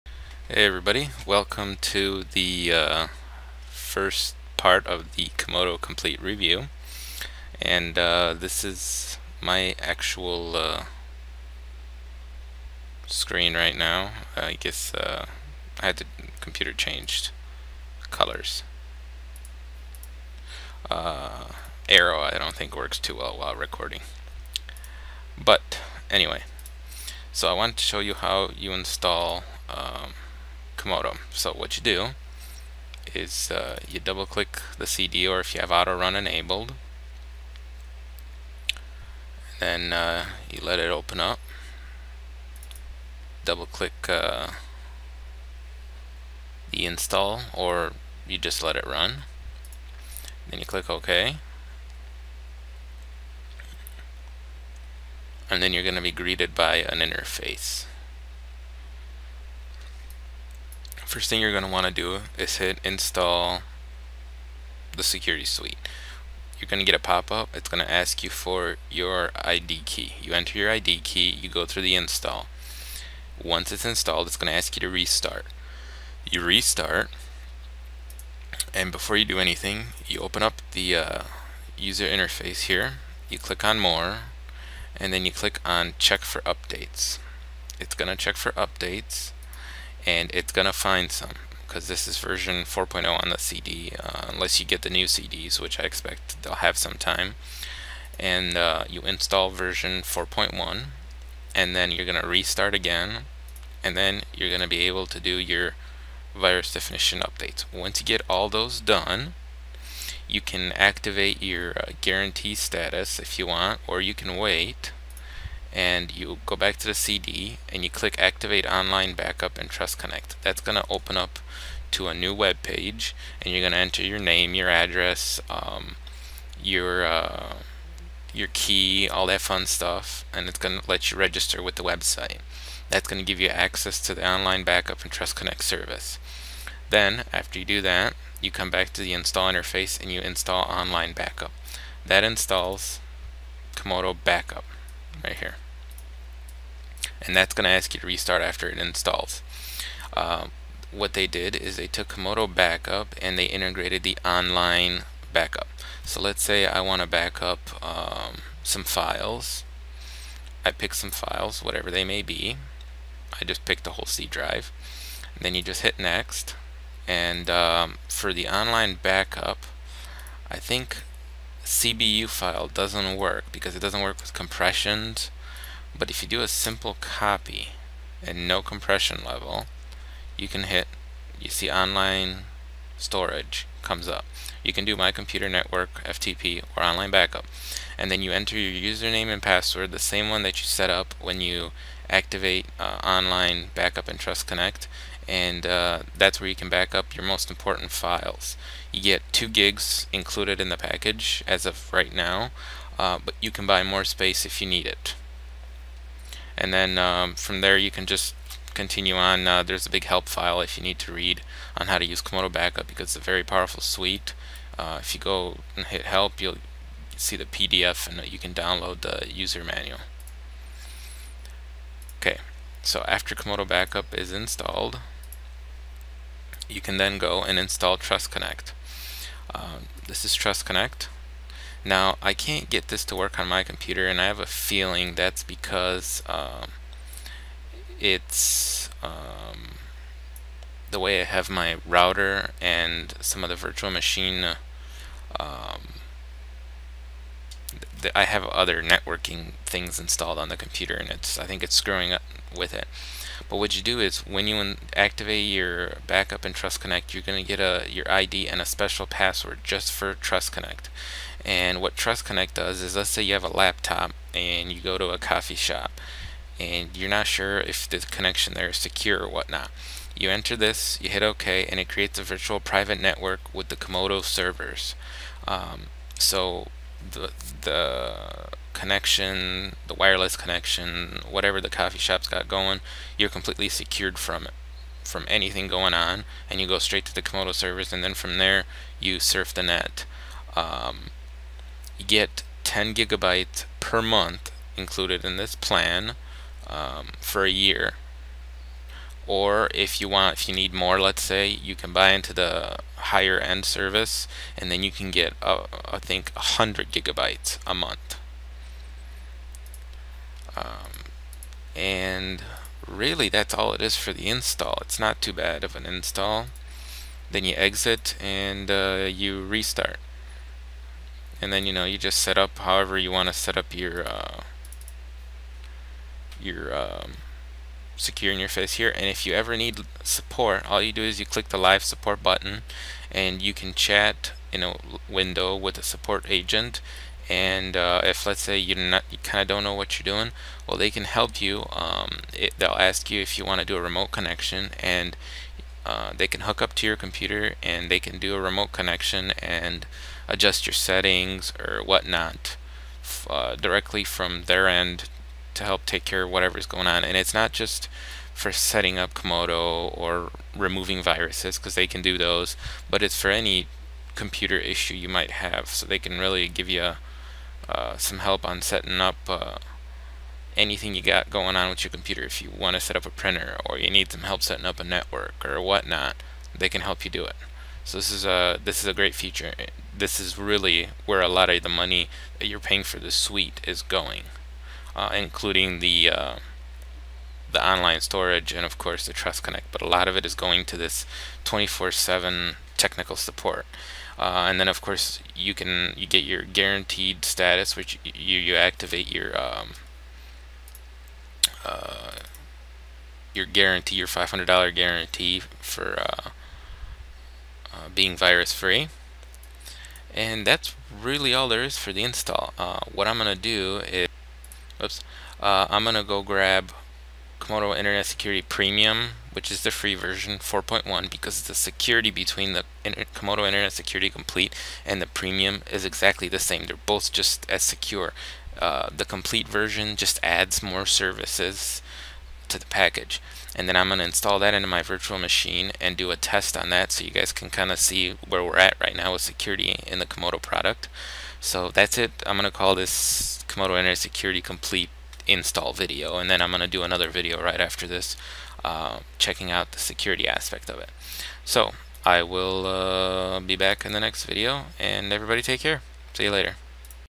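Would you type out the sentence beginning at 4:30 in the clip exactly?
You enter this, you hit OK, and it creates a virtual private network with the Comodo servers.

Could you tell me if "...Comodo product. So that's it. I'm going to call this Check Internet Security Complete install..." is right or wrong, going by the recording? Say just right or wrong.
wrong.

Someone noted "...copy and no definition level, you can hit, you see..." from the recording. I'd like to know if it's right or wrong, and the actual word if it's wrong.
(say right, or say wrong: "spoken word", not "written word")
wrong: "compression", not "definition".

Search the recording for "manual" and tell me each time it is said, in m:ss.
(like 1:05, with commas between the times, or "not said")
3:39.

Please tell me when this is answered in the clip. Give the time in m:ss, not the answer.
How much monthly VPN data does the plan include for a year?
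4:52.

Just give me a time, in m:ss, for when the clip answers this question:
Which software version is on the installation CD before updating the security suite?
1:32.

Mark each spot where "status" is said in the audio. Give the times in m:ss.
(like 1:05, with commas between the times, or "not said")
1:52, 6:37.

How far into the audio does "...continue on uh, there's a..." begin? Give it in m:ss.
3:28.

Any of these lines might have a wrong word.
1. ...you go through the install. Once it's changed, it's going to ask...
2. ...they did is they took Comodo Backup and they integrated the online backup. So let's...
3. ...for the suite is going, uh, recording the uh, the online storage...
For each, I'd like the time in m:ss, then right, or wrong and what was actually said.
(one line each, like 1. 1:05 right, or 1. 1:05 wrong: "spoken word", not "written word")
1. 1:11 wrong: "installed", not "changed"
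2. 2:31 right
3. 6:22 wrong: "including", not "recording".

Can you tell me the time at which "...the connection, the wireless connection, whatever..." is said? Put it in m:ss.
4:37.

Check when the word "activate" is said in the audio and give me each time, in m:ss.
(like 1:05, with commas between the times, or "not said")
1:50, 1:58, 3:12, 4:14, 6:38.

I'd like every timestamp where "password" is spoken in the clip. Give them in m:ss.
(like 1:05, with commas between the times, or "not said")
3:09, 4:19.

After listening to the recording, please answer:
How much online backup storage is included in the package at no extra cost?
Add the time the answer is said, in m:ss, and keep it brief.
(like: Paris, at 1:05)
2 gigs, at 3:19.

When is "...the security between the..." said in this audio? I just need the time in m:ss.
7:01.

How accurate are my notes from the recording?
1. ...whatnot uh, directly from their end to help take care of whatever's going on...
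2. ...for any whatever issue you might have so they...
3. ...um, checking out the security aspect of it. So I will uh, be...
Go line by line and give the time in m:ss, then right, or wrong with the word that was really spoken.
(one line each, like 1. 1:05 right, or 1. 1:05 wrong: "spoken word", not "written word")
1. 5:51 right
2. 6:03 wrong: "computer", not "whatever"
3. 7:28 right.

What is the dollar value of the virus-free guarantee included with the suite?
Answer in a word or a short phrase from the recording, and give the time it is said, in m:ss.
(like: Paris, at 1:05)
$500, at 6:44.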